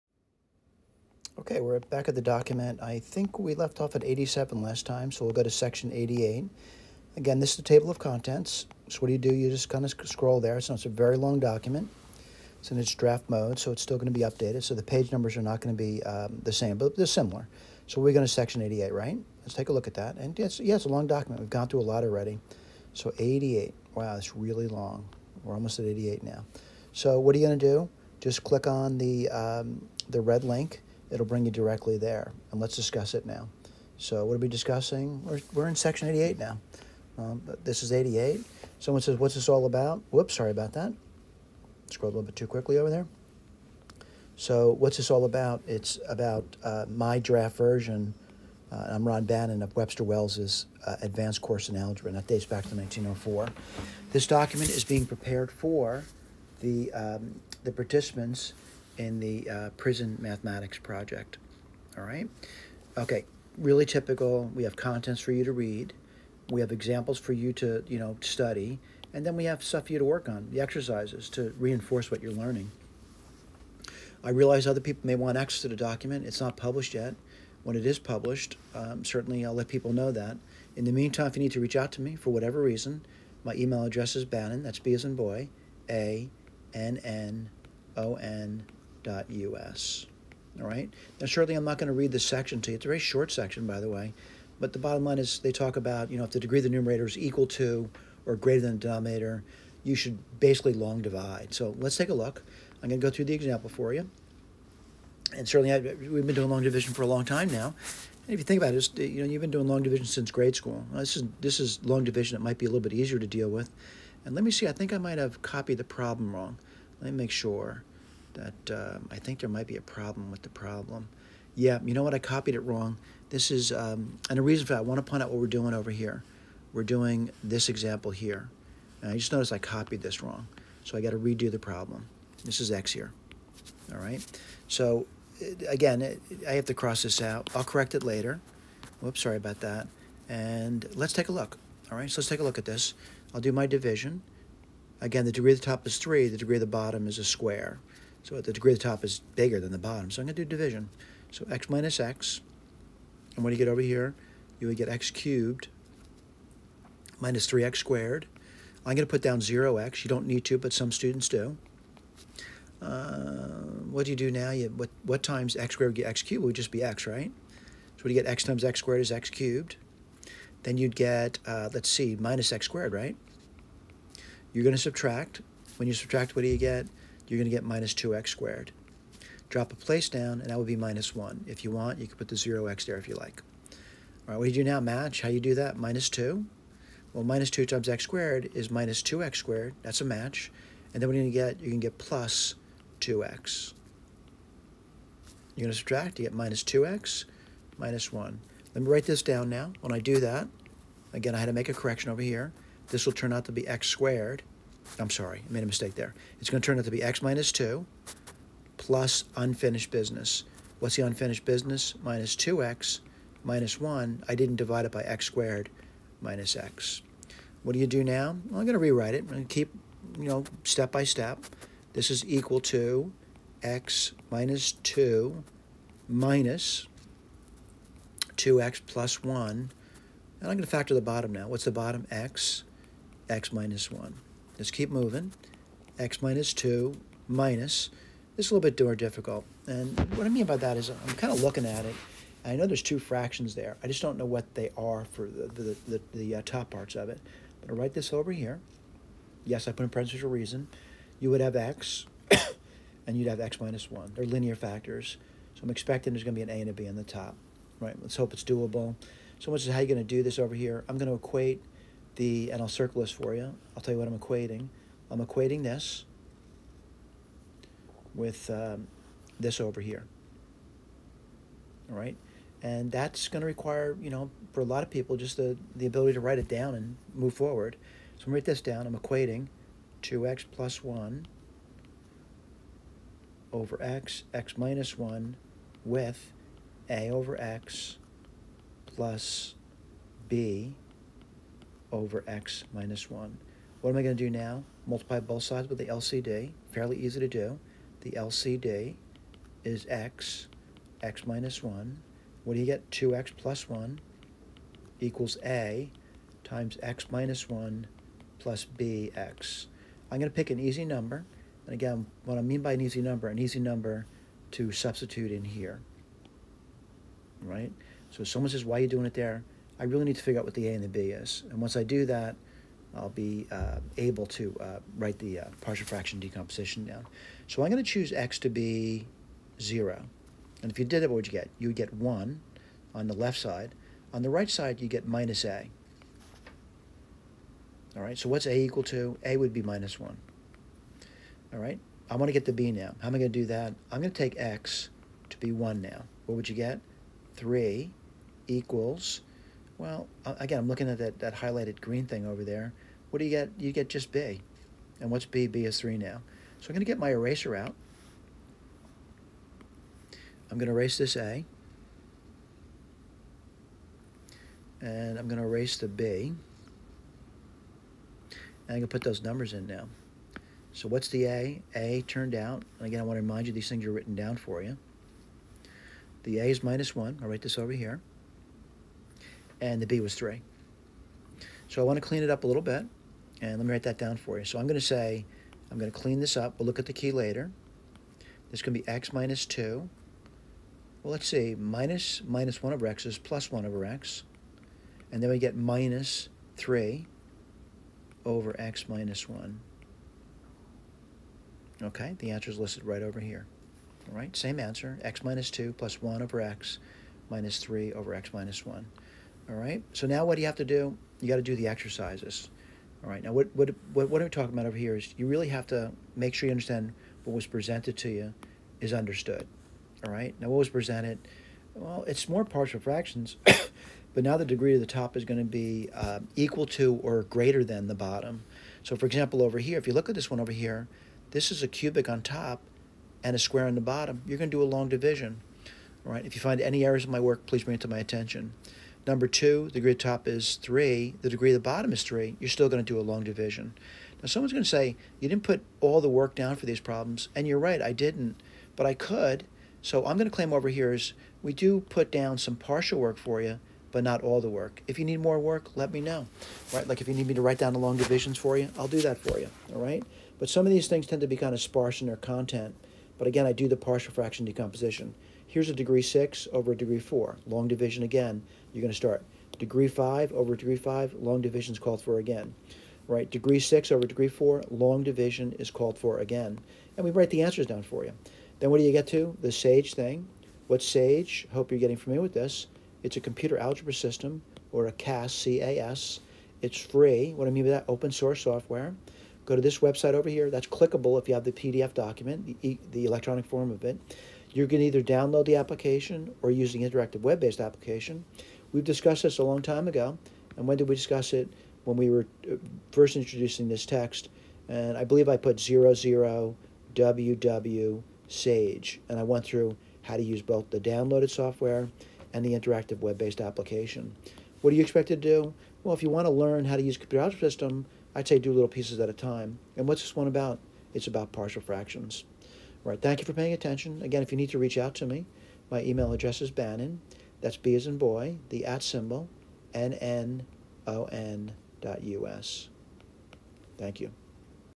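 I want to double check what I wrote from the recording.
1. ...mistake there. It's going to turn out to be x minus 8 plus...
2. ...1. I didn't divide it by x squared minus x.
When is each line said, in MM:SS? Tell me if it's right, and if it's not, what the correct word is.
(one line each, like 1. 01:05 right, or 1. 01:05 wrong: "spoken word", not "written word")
1. 03:25 wrong: "2", not "8"
2. 03:33 right.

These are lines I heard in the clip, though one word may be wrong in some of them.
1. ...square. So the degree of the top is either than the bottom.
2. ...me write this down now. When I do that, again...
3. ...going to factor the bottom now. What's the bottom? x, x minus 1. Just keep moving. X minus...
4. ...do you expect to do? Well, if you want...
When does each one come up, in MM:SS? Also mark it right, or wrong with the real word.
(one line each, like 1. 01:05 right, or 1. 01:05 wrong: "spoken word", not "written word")
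1. 02:27 wrong: "bigger", not "either"
2. 03:18 right
3. 03:50 right
4. 08:34 right.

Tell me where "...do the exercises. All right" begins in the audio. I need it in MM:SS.
06:51.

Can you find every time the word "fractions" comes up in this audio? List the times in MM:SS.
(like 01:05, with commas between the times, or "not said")
04:02, 05:25, 07:02, 07:44, 08:41.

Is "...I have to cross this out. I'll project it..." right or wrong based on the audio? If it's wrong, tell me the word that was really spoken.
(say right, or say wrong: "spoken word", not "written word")
wrong: "correct", not "project".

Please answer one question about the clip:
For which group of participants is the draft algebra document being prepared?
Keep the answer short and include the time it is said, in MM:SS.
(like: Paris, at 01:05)
prison mathematics project, at 00:59.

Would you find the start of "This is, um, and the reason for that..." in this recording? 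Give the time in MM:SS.
02:03.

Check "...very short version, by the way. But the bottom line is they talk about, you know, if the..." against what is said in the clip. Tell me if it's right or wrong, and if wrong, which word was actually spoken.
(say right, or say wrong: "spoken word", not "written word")
wrong: "section", not "version".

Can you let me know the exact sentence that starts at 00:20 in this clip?
And yes, yeah, it's a long document.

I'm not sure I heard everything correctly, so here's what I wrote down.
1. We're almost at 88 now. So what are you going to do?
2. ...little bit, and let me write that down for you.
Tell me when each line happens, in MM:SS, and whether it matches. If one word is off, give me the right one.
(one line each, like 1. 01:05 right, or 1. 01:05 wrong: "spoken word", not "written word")
1. 00:25 right
2. 06:22 right.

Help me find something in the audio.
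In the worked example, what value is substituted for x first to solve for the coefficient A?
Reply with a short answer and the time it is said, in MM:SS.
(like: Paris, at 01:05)
0, at 05:29.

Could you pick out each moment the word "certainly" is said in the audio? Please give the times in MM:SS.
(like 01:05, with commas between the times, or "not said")
01:19, 01:45.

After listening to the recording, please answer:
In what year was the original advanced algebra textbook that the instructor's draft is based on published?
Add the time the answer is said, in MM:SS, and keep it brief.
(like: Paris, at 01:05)
1904, at 00:52.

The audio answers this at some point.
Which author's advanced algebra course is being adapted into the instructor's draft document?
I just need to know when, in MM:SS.
00:49.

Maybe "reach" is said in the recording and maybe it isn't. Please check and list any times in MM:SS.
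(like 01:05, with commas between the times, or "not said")
01:21, 08:44.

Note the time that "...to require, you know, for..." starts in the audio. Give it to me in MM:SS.
04:33.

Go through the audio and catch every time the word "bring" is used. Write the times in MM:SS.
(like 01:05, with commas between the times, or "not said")
00:31, 07:17.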